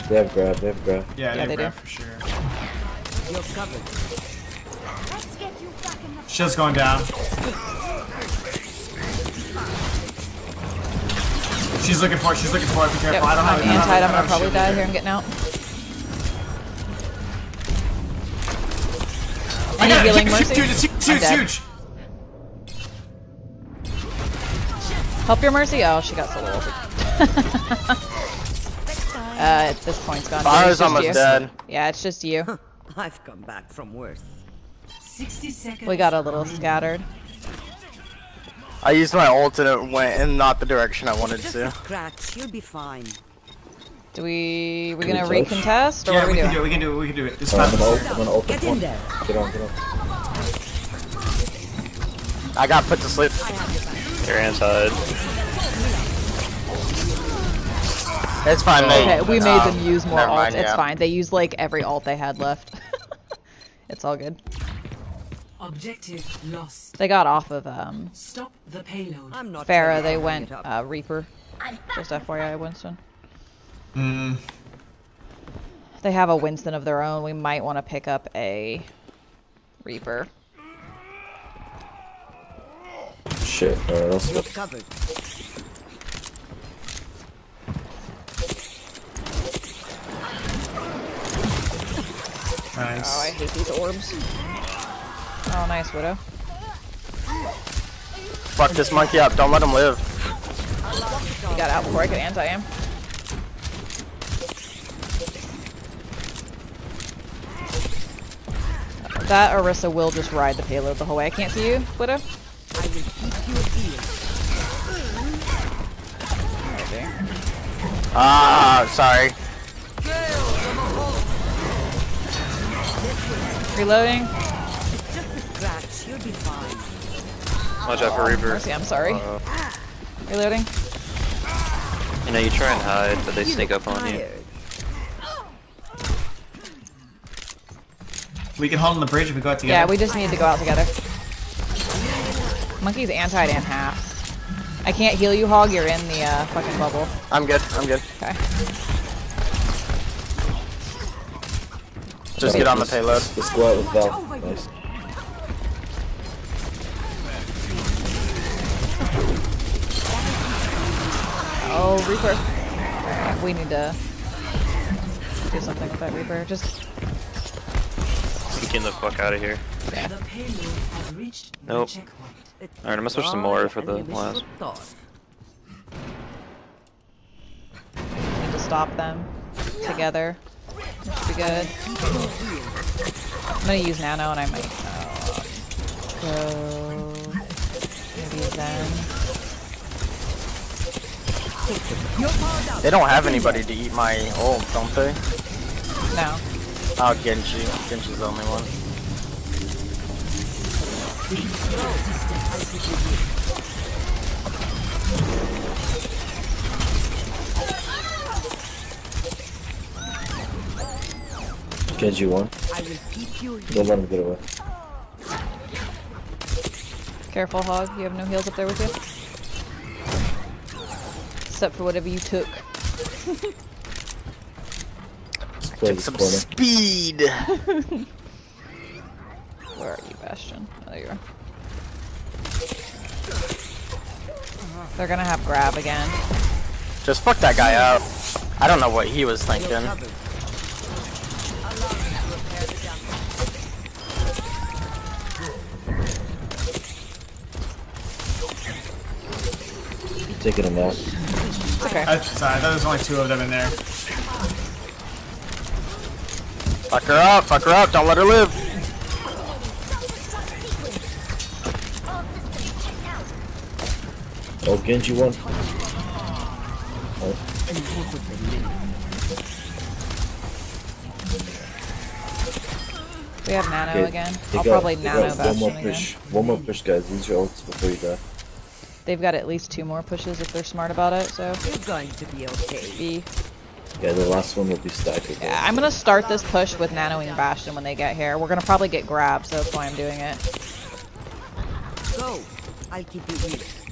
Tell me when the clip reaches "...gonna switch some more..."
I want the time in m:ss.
2:52.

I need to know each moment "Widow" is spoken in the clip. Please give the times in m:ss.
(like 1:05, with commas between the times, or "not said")
1:35, 1:51.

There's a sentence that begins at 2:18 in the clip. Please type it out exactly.
We can hold on the bridge if we go out together.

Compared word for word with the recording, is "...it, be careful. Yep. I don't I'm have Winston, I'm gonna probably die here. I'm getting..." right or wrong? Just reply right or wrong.
wrong.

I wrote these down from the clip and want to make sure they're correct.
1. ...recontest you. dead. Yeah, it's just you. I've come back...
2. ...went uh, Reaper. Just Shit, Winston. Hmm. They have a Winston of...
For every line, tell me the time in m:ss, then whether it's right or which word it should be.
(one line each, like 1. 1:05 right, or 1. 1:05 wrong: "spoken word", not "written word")
1. 0:30 wrong: "almost", not "recontest"
2. 1:10 wrong: "FYI", not "Shit".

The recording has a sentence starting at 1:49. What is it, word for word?
That Orisa will just ride the payload the whole way.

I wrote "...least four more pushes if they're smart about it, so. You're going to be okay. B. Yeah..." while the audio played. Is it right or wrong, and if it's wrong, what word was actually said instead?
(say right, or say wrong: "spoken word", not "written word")
wrong: "two", not "four".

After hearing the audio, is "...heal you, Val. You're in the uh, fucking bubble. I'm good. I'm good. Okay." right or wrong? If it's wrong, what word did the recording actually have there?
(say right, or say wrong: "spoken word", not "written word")
wrong: "Hog", not "Val".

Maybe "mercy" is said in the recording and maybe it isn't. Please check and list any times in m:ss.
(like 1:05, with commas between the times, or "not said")
0:20, 0:25, 2:08.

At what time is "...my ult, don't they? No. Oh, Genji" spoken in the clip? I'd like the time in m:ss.
3:13.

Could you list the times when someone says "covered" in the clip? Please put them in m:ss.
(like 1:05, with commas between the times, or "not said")
0:03.